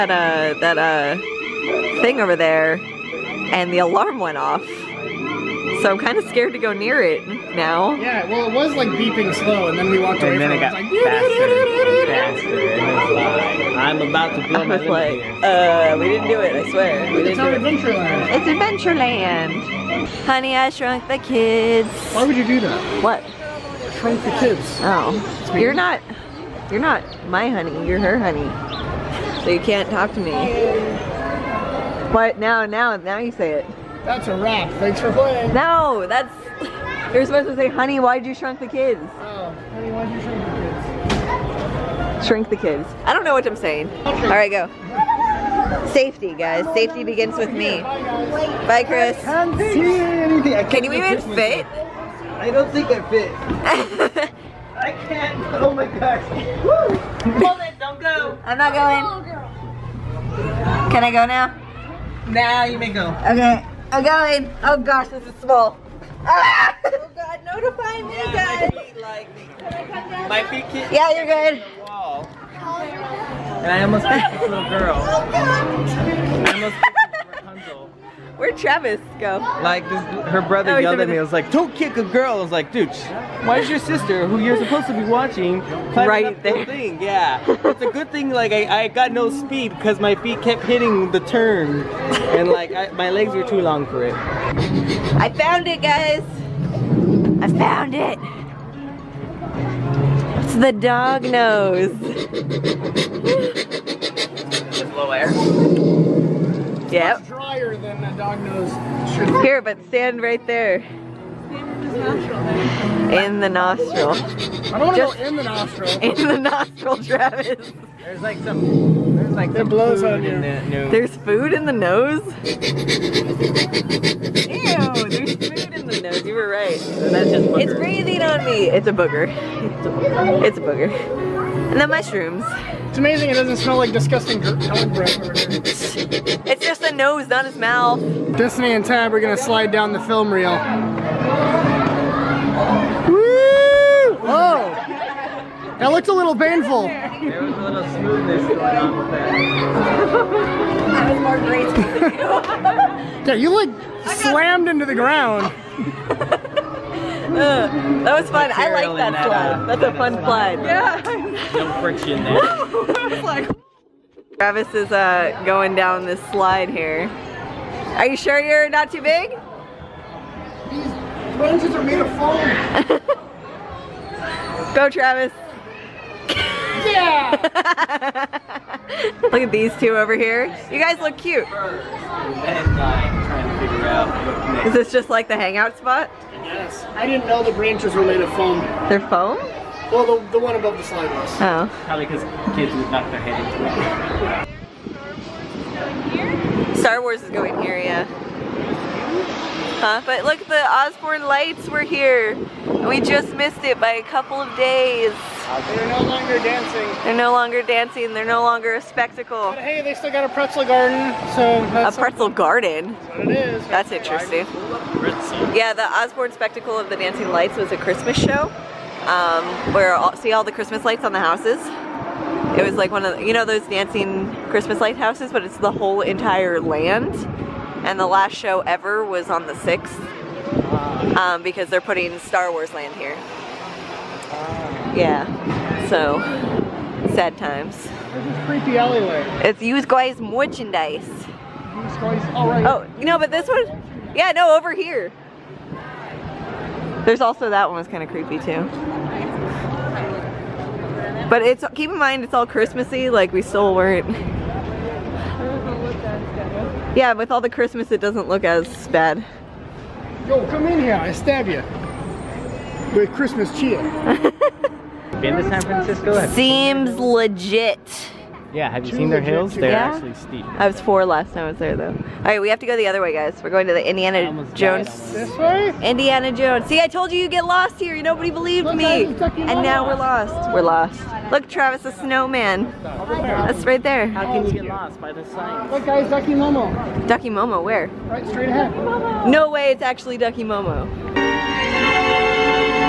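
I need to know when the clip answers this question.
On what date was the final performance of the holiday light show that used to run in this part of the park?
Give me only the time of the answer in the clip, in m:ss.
3:49.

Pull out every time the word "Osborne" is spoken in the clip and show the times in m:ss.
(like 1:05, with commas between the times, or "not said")
3:20, 3:35.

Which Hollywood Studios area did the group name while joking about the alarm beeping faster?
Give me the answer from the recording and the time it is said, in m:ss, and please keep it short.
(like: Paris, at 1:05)
Honey, I Shrunk the Kids, at 0:20.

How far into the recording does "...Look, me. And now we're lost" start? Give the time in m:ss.
4:38.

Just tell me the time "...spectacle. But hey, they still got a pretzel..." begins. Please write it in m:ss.
3:28.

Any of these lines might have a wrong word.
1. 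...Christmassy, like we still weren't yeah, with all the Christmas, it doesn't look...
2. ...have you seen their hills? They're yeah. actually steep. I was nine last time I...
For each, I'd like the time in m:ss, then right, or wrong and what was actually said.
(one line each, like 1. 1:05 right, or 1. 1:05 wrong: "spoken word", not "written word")
1. 4:12 right
2. 4:28 wrong: "four", not "nine".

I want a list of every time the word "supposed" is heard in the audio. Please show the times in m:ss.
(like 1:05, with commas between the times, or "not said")
0:37, 1:24.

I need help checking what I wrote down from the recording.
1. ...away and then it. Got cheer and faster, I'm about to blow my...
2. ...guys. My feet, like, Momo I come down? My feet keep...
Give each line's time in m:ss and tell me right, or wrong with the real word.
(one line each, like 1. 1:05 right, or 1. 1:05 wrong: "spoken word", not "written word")
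1. 0:10 wrong: "faster", not "cheer"
2. 1:08 wrong: "Can", not "Momo".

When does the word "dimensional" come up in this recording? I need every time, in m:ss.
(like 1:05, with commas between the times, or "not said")
not said.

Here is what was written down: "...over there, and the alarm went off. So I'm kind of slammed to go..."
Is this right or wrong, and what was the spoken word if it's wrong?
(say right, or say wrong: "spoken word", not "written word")
wrong: "scared", not "slammed".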